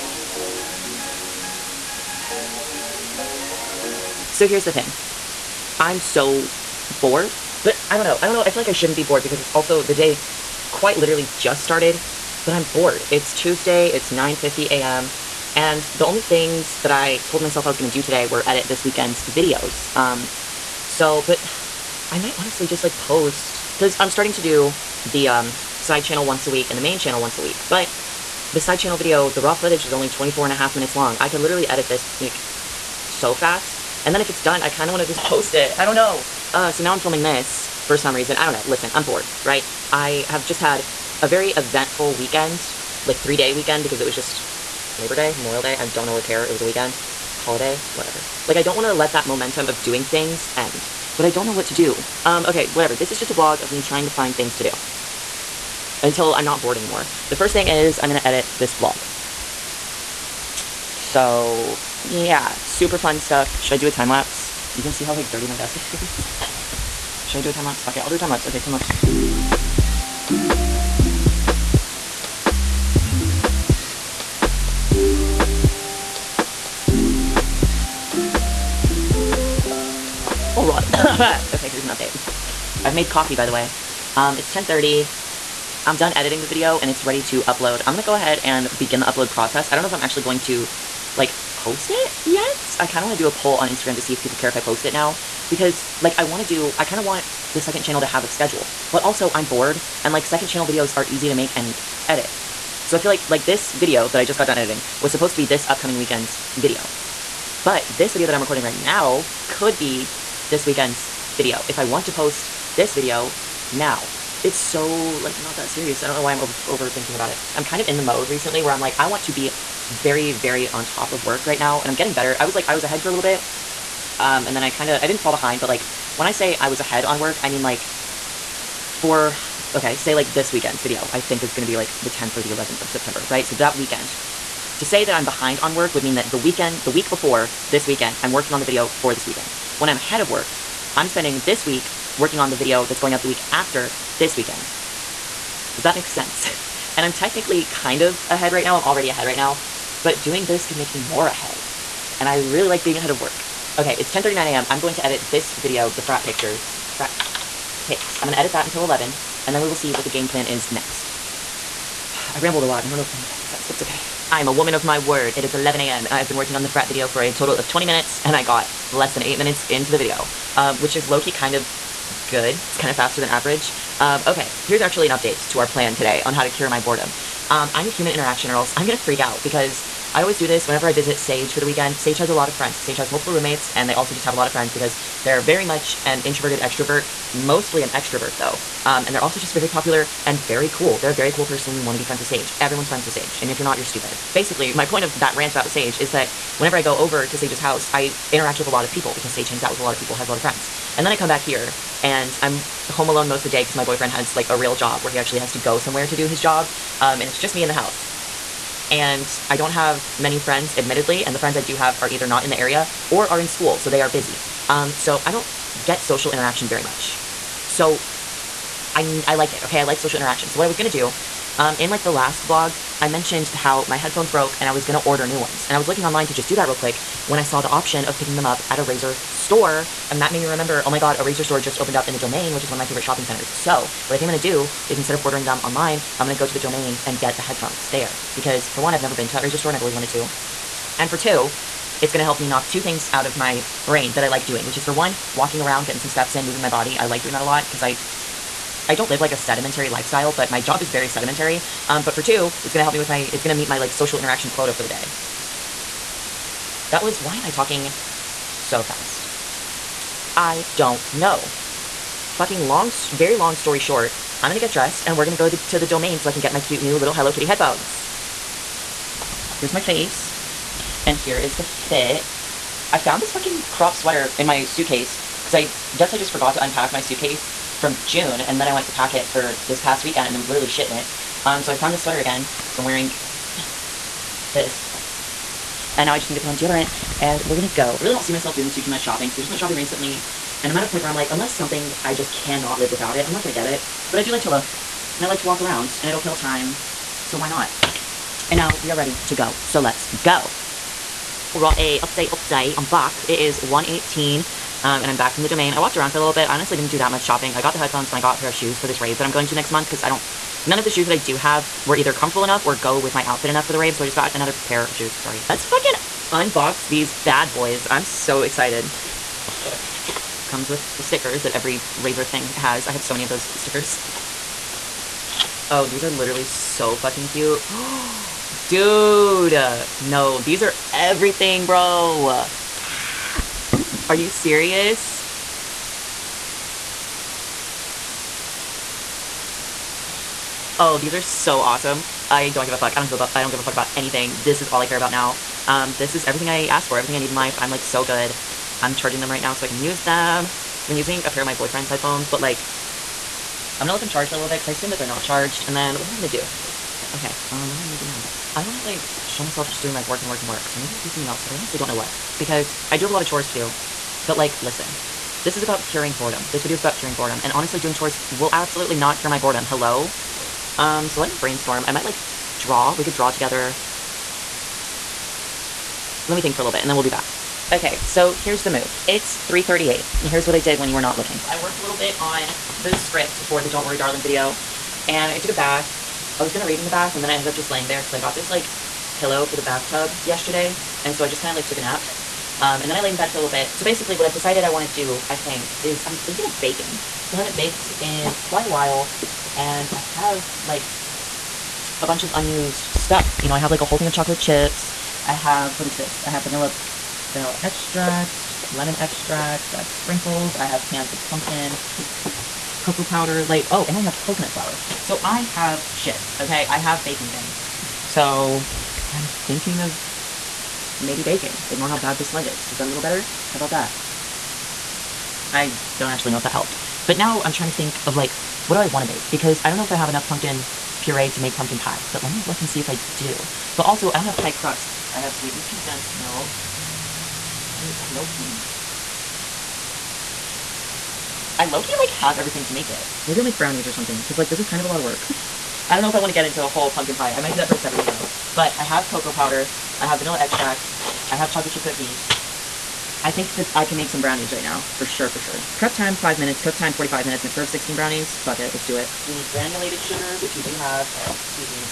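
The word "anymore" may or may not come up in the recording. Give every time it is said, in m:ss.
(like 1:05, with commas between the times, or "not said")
0:56.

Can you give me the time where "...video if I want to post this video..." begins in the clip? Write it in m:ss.
1:51.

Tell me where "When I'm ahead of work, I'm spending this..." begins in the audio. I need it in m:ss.
2:19.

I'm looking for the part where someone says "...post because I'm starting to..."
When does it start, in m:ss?
0:22.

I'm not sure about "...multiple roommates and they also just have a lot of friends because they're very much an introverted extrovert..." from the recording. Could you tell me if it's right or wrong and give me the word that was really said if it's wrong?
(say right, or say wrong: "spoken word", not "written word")
right.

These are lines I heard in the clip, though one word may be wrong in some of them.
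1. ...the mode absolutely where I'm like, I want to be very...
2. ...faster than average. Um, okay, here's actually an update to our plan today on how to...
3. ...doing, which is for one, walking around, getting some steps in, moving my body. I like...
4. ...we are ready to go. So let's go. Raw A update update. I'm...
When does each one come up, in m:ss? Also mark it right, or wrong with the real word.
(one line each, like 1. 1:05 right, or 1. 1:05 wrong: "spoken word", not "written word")
1. 1:57 wrong: "recently", not "absolutely"
2. 2:52 right
3. 4:04 right
4. 4:58 right.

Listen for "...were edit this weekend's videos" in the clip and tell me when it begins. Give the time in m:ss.
0:18.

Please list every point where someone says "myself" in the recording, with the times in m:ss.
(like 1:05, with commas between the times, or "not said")
0:17, 4:48, 5:59.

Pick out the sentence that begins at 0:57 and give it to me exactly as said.
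The first thing is I'm going to edit this vlog.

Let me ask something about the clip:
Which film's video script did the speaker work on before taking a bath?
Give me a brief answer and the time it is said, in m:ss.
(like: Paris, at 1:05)
Don't Worry Darling, at 6:23.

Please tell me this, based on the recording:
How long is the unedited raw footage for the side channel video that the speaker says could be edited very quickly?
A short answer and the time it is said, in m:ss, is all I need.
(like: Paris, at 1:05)
24 and a half minutes, at 0:30.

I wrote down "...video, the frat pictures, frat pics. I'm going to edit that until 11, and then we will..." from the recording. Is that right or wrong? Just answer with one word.
right.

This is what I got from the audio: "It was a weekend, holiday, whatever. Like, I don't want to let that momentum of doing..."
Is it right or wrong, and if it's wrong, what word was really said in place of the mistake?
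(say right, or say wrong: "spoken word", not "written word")
right.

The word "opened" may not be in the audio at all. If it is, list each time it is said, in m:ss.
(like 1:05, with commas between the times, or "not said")
3:51.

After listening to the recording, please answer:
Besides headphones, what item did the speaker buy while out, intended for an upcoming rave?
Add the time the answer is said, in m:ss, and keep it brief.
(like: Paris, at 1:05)
a pair of shoes, at 5:08.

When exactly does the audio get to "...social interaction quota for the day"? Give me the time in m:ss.
4:13.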